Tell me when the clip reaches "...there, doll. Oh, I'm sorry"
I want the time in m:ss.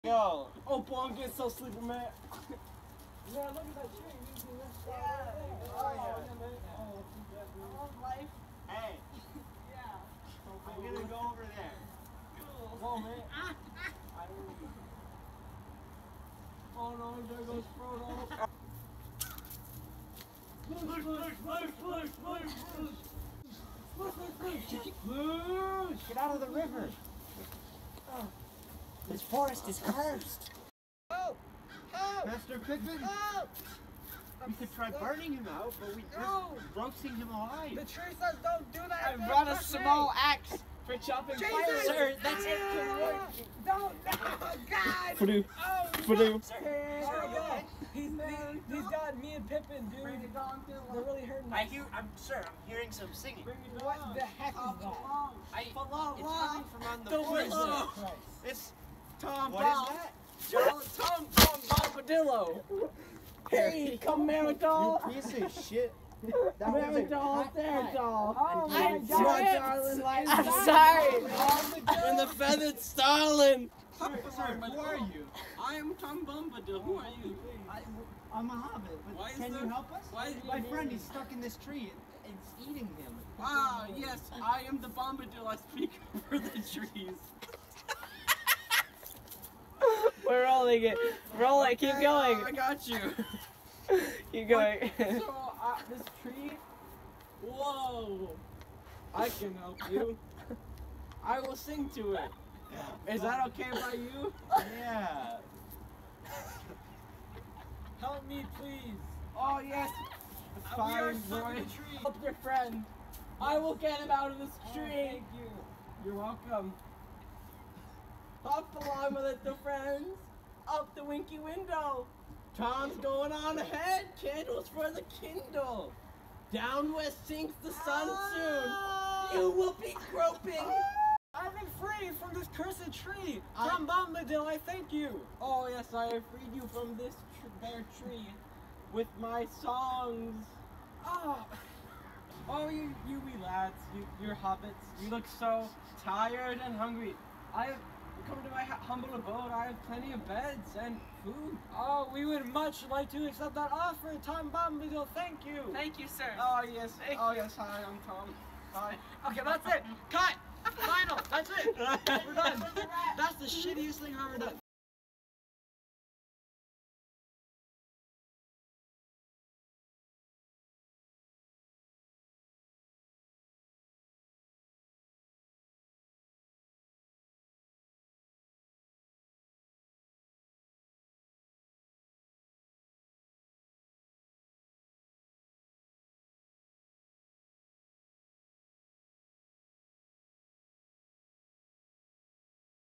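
1:07.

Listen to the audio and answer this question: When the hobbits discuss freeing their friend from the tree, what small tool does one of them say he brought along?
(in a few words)
A small axe.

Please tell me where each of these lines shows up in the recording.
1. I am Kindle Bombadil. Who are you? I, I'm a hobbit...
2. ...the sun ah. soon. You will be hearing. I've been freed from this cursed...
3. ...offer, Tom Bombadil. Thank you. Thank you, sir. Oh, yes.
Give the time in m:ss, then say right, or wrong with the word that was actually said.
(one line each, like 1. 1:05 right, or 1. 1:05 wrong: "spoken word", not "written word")
1. 1:15 wrong: "Tom", not "Kindle"
2. 2:07 wrong: "groping", not "hearing"
3. 2:33 right.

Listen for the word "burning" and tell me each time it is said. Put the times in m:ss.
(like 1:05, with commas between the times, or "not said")
0:34.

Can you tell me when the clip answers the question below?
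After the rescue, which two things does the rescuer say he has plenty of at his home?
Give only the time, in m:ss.
2:30.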